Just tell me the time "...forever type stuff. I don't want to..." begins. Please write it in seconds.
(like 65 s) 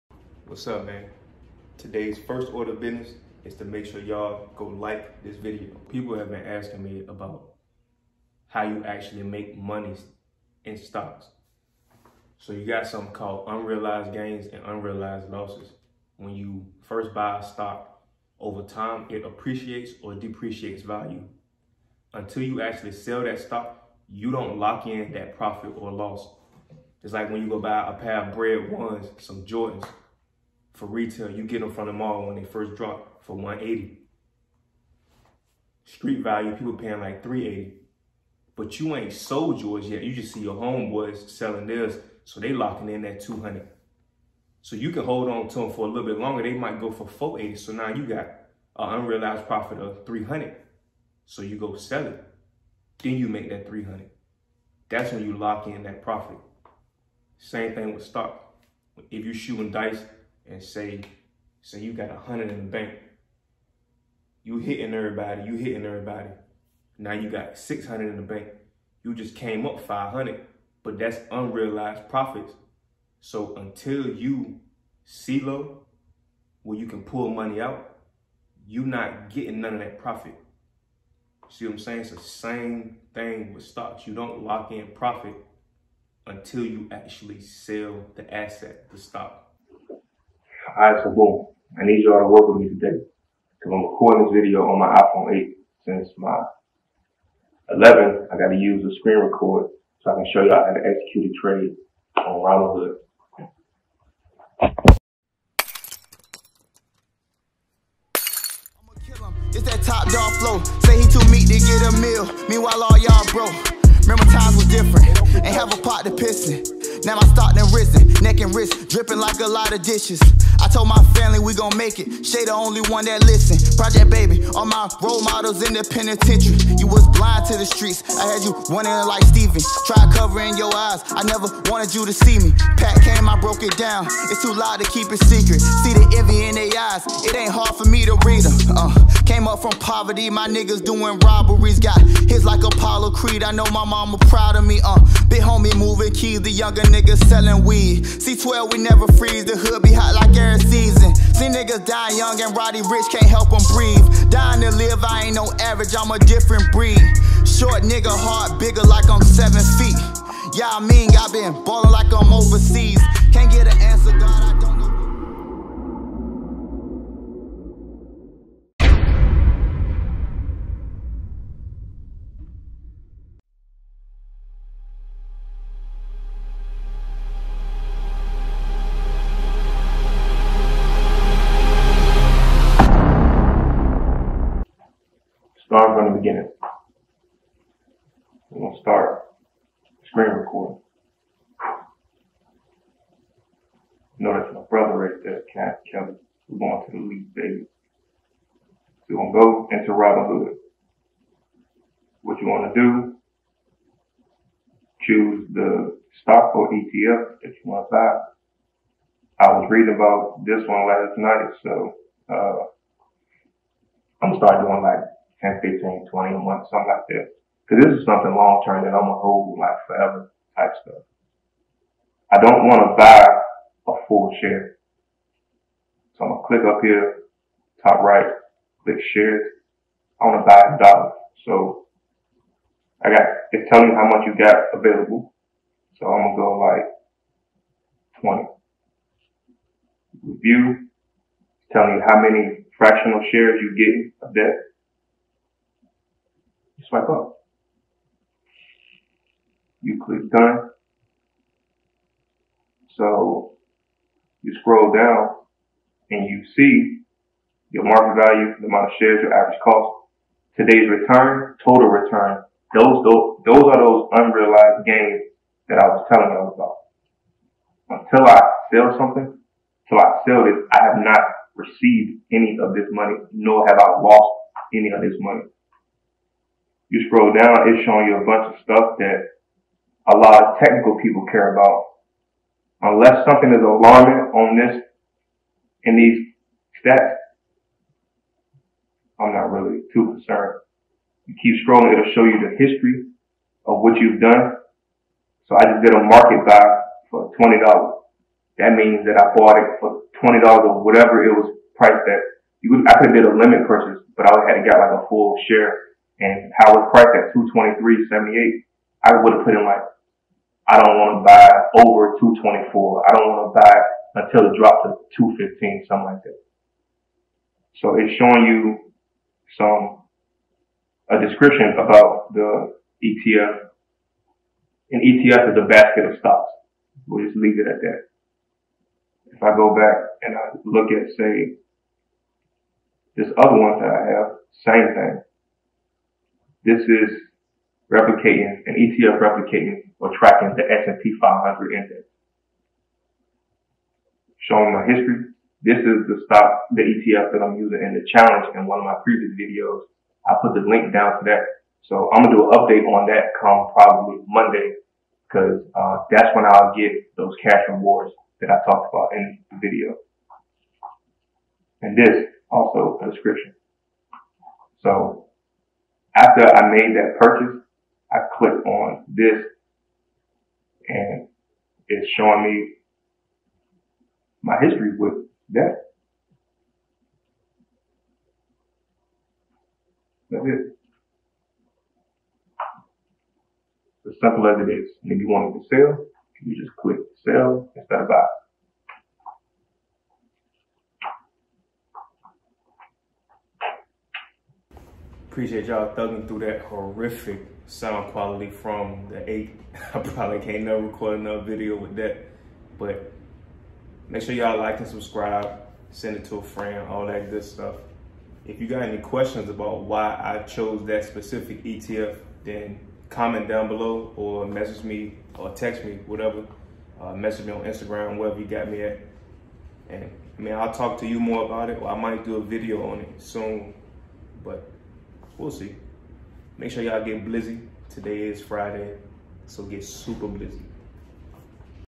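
219 s.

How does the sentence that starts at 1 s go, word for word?
Today's first order of business is to make sure y'all go like this video.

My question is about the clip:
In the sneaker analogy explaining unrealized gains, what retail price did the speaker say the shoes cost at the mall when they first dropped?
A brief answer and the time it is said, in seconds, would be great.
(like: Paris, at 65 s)
180, at 33 s.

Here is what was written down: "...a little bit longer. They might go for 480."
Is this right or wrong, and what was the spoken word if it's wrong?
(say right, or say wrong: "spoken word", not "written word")
right.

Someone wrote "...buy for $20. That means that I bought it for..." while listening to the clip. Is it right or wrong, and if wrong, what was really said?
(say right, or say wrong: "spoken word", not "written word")
right.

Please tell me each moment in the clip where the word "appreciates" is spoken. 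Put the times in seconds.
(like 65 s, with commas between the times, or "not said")
19 s, 395 s.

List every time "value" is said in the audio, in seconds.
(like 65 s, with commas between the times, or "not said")
20 s, 36 s, 258 s.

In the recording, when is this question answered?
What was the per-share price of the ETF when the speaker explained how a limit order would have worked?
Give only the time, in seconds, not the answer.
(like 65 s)
307 s.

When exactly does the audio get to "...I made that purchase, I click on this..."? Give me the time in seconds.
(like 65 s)
366 s.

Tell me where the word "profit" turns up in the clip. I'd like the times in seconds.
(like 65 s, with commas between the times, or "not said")
25 s, 49 s, 56 s, 72 s, 79 s, 84 s.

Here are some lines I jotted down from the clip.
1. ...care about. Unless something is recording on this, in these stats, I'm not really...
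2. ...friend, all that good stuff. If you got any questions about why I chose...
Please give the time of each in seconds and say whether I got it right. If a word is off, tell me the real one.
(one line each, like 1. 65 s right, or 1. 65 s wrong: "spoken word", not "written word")
1. 281 s wrong: "alarming", not "recording"
2. 406 s right.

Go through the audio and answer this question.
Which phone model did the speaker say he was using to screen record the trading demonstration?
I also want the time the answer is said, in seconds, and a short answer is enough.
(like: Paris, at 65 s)
iPhone 8, at 94 s.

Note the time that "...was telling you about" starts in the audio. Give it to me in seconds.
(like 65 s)
265 s.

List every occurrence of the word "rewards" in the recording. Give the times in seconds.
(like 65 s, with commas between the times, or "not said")
357 s.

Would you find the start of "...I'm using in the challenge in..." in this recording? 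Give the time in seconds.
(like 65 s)
347 s.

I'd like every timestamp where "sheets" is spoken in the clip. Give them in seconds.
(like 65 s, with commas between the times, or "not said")
not said.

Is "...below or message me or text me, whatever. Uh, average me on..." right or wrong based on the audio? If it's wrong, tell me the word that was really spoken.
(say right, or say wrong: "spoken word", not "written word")
wrong: "message", not "average".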